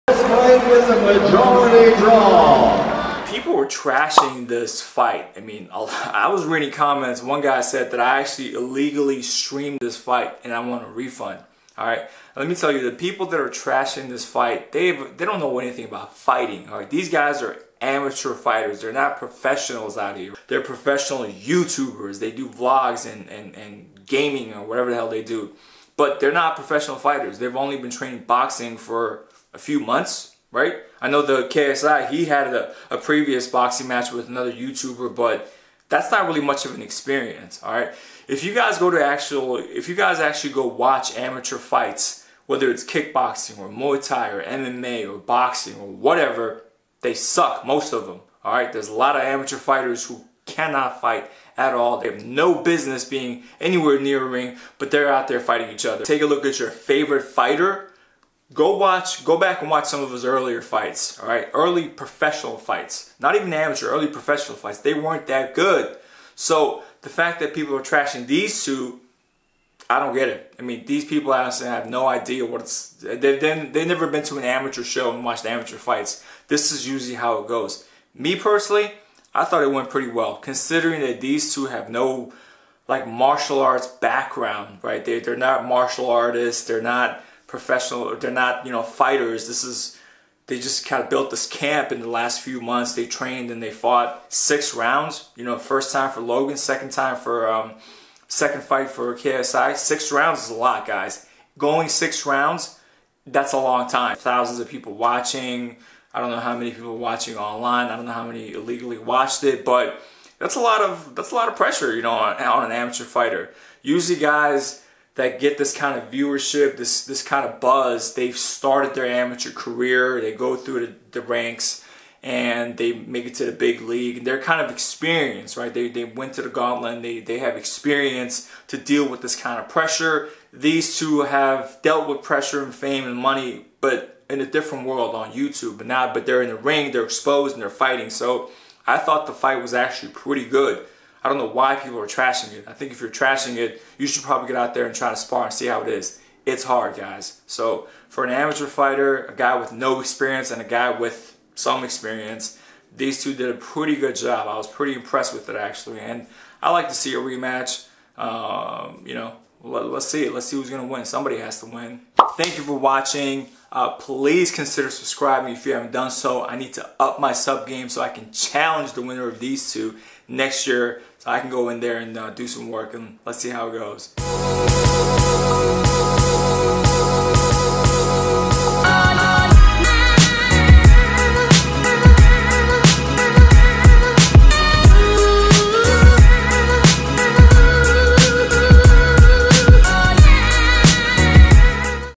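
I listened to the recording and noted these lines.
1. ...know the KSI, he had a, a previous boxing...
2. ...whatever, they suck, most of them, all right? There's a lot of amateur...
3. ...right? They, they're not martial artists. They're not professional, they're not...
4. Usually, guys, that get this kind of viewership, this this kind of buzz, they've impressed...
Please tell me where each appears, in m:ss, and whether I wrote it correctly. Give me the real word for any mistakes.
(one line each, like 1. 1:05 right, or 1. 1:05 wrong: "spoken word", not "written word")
1. 0:31 right
2. 0:45 right
3. 1:24 right
4. 1:53 wrong: "started", not "impressed".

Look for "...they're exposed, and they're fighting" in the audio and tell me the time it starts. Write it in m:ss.
2:16.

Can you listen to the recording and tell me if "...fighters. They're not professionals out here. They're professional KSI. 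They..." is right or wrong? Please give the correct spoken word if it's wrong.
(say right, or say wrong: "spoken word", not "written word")
wrong: "YouTubers", not "KSI".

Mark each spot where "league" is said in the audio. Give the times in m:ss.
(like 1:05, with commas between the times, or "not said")
2:03.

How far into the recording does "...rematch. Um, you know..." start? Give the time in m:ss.
2:37.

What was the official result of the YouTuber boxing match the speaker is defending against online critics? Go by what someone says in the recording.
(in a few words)
Majority draw.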